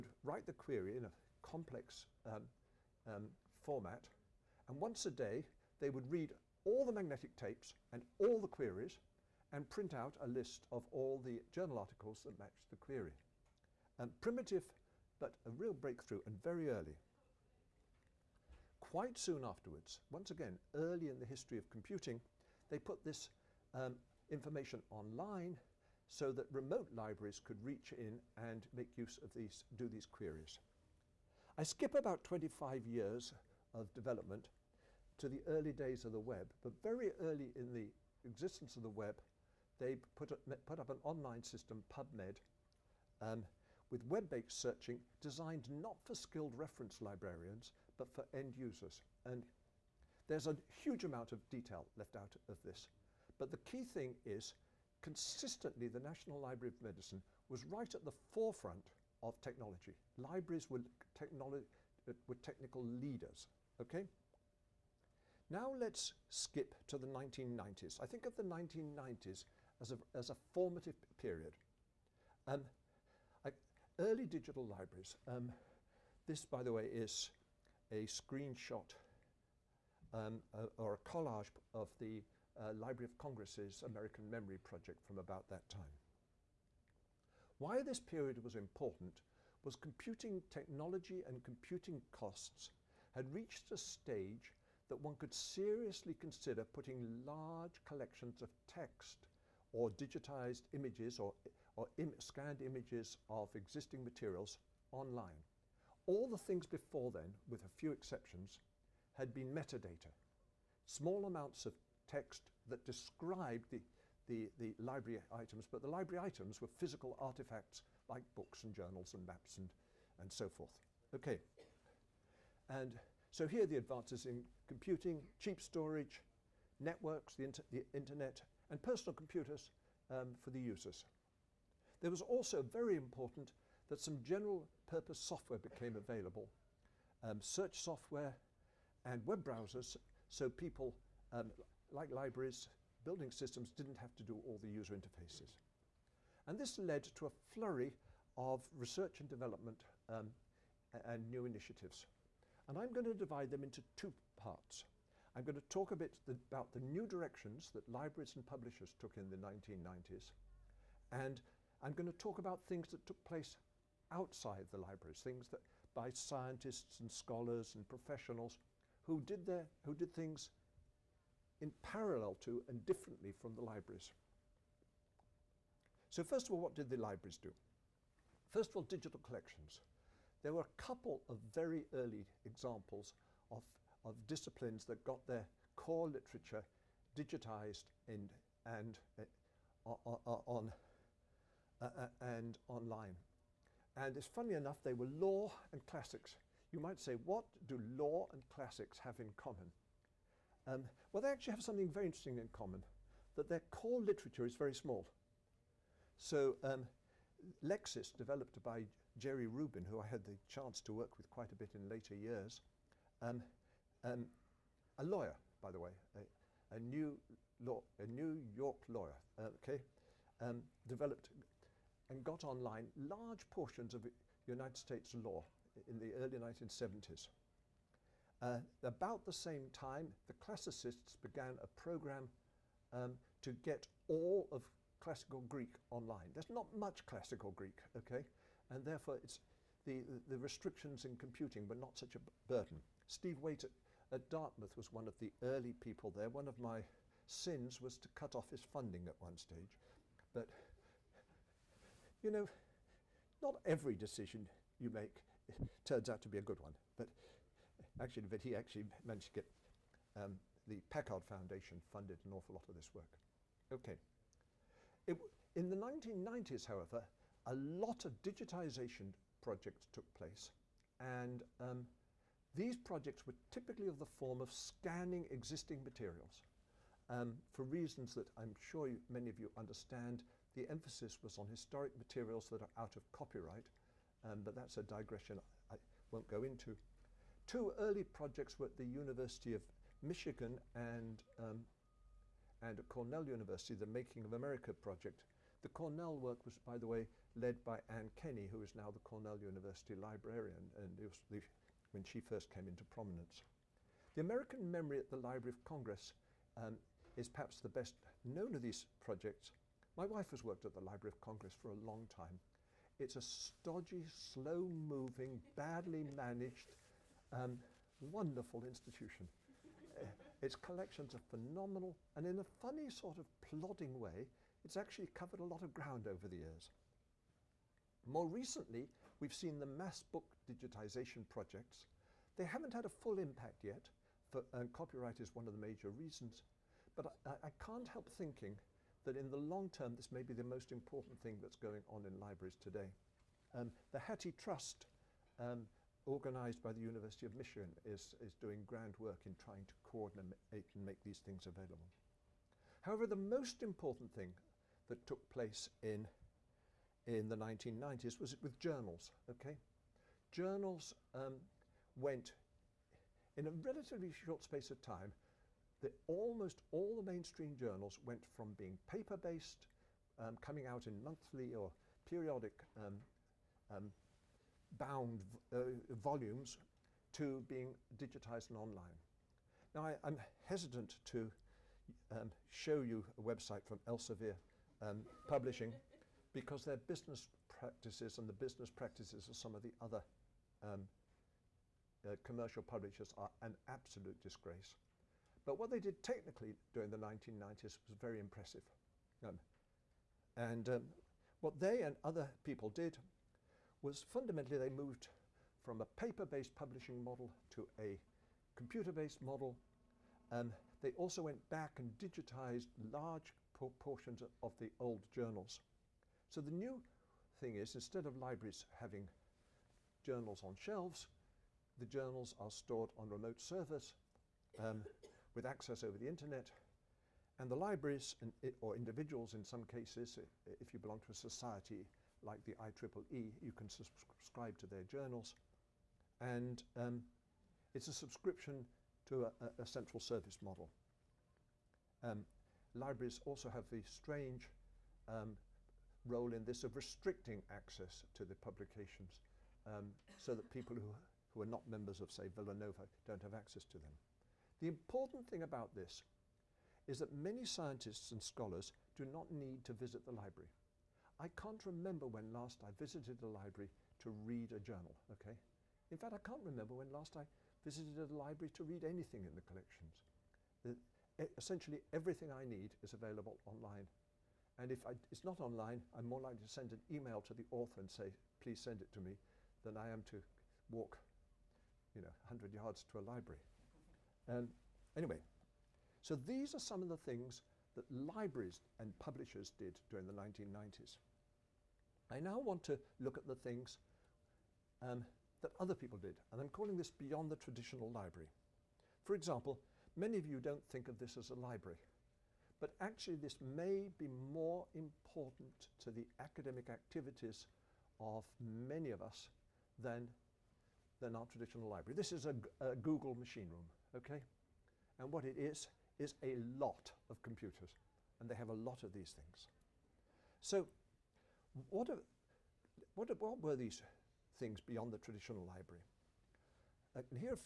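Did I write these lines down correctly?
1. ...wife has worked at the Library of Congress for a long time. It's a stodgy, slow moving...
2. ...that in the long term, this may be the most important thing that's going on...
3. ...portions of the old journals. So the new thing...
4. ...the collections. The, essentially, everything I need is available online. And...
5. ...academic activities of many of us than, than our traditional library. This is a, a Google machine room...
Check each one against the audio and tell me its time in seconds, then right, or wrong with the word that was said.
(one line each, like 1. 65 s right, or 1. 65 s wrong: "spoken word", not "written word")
1. 310 s right
2. 339 s right
3. 413 s right
4. 469 s right
5. 506 s right.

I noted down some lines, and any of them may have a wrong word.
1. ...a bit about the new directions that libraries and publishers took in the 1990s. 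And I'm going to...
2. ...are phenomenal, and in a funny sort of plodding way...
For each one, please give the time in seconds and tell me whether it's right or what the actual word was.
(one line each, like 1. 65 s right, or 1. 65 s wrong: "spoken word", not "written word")
1. 155 s right
2. 321 s right.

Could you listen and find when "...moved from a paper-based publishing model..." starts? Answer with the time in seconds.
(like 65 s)
404 s.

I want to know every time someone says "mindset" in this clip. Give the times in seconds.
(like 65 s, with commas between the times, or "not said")
not said.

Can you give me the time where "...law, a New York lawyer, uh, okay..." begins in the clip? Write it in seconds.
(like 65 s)
217 s.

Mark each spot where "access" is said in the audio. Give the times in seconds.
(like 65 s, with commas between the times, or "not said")
425 s, 447 s, 453 s.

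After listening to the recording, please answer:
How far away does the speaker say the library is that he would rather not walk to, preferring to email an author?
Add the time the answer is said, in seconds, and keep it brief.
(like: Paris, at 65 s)
100 yards, at 482 s.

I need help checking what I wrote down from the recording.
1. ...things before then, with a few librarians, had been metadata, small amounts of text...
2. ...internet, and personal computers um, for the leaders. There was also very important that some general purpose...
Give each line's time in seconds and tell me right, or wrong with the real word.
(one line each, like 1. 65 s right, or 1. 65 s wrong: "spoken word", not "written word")
1. 106 s wrong: "exceptions", not "librarians"
2. 127 s wrong: "users", not "leaders".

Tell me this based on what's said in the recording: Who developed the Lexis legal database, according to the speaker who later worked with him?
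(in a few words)
Jerry Rubin.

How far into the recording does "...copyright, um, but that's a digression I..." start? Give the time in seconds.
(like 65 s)
283 s.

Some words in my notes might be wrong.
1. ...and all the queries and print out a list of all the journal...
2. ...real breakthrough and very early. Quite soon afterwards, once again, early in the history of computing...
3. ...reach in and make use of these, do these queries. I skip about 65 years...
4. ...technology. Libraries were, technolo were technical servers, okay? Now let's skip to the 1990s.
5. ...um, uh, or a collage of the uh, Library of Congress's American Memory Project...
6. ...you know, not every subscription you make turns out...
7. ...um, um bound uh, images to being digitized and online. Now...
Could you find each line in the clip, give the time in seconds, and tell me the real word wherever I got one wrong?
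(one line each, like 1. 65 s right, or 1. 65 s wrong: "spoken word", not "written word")
1. 7 s right
2. 15 s right
3. 27 s wrong: "25", not "65"
4. 59 s wrong: "leaders", not "servers"
5. 80 s right
6. 252 s wrong: "decision", not "subscription"
7. 372 s wrong: "volumes", not "images".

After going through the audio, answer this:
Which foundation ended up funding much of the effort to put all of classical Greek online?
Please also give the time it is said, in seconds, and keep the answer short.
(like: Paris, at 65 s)
Packard Foundation, at 260 s.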